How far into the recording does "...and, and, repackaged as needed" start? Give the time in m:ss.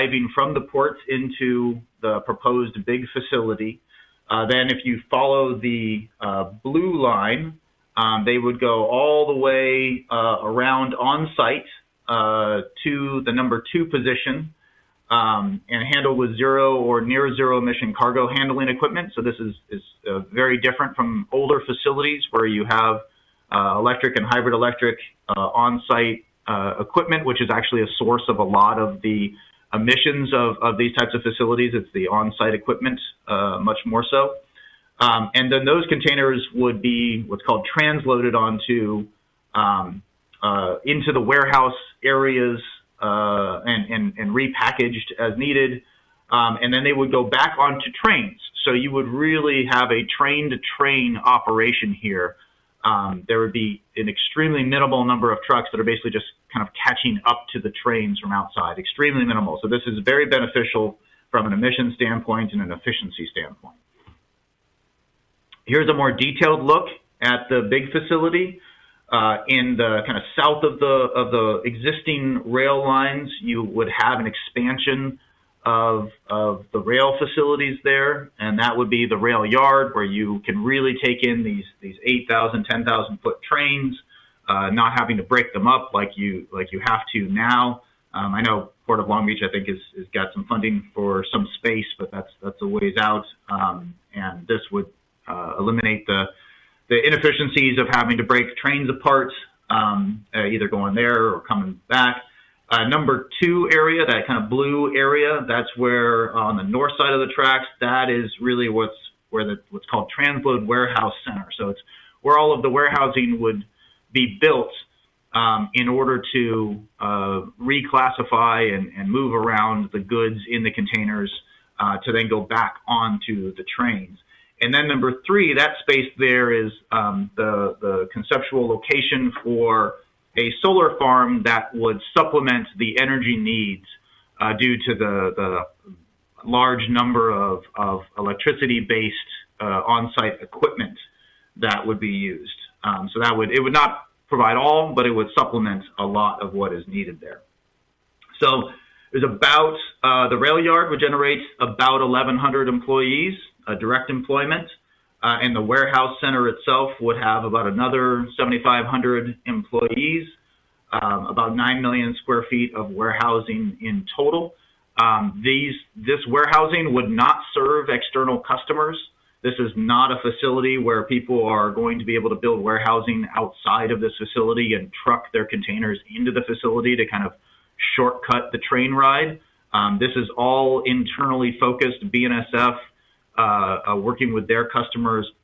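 0:43.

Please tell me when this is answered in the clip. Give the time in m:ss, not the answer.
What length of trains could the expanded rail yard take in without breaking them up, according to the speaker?
1:22.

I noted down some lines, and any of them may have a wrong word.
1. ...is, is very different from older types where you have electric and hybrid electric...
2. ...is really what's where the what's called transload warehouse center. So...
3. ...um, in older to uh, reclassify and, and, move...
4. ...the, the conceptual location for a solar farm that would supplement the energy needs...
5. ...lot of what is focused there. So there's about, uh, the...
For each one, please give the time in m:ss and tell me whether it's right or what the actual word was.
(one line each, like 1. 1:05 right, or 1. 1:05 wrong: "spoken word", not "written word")
1. 0:19 wrong: "facilities", not "types"
2. 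1:48 right
3. 1:55 wrong: "order", not "older"
4. 2:07 right
5. 2:26 wrong: "needed", not "focused".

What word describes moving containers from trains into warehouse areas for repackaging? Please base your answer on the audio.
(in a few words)
transloaded.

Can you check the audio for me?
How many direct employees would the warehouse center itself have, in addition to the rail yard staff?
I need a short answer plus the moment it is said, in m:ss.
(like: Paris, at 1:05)
7,500, at 2:38.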